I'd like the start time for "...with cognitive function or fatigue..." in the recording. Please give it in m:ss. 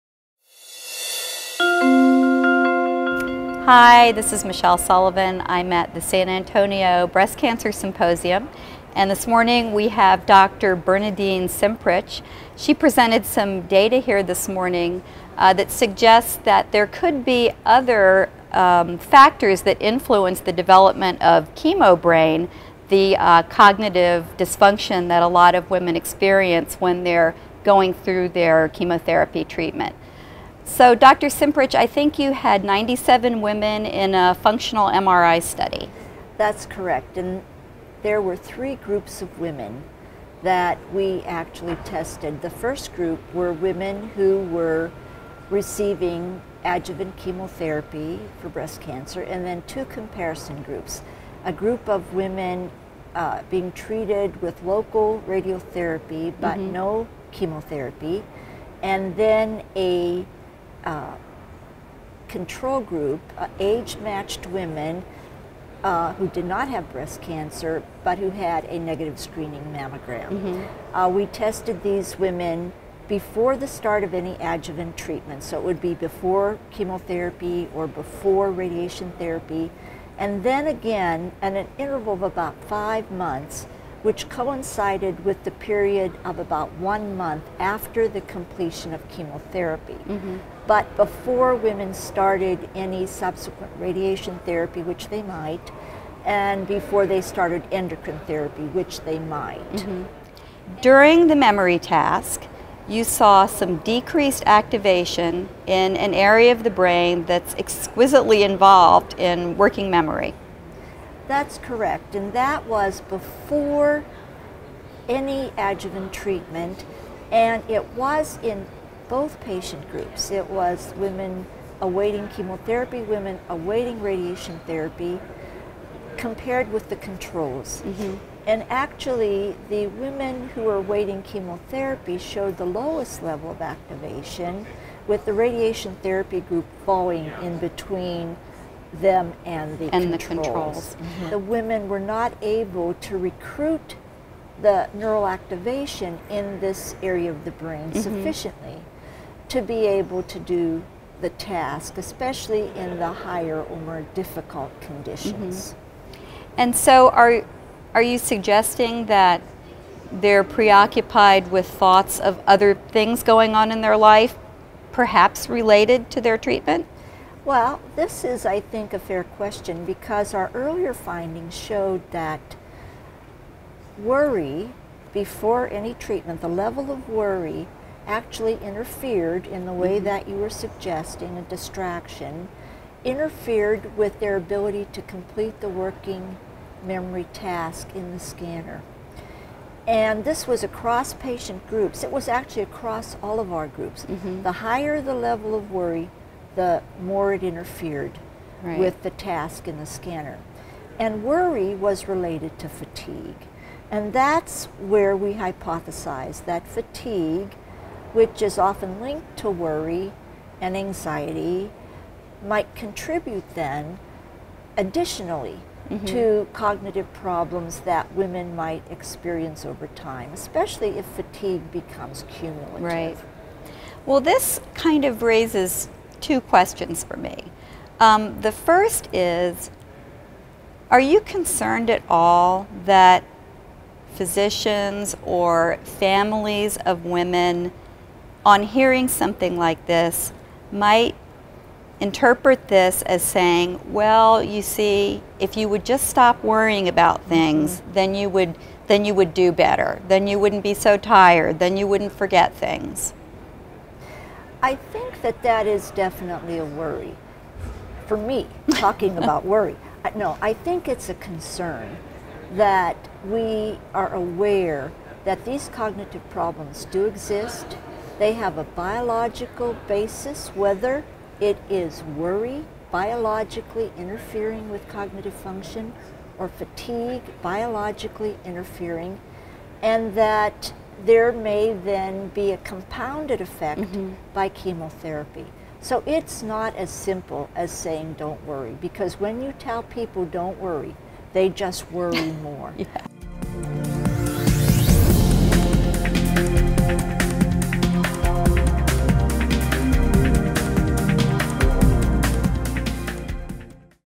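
4:34.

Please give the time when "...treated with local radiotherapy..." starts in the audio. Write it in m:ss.
0:53.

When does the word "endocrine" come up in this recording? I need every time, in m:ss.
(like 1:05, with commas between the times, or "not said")
1:37.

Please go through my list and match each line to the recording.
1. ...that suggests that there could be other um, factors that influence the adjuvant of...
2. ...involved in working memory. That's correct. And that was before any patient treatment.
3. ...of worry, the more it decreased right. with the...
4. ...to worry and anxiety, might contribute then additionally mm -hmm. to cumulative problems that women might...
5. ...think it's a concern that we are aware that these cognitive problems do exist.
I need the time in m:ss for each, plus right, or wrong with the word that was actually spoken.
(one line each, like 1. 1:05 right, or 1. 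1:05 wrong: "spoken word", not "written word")
1. 0:15 wrong: "development", not "adjuvant"
2. 1:48 wrong: "adjuvant", not "patient"
3. 3:15 wrong: "interfered", not "decreased"
4. 3:29 wrong: "cognitive", not "cumulative"
5. 4:20 right.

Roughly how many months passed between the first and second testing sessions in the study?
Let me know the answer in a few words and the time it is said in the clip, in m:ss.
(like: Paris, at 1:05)
5, at 1:22.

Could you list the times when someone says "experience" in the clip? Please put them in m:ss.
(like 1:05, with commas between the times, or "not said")
0:25, 3:38.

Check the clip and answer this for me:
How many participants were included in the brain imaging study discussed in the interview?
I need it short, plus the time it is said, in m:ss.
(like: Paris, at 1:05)
97, at 0:32.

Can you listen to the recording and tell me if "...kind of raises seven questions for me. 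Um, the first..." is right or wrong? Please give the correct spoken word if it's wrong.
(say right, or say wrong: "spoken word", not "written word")
wrong: "two", not "seven".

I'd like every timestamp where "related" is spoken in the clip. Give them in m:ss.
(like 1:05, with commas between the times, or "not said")
2:45, 3:22.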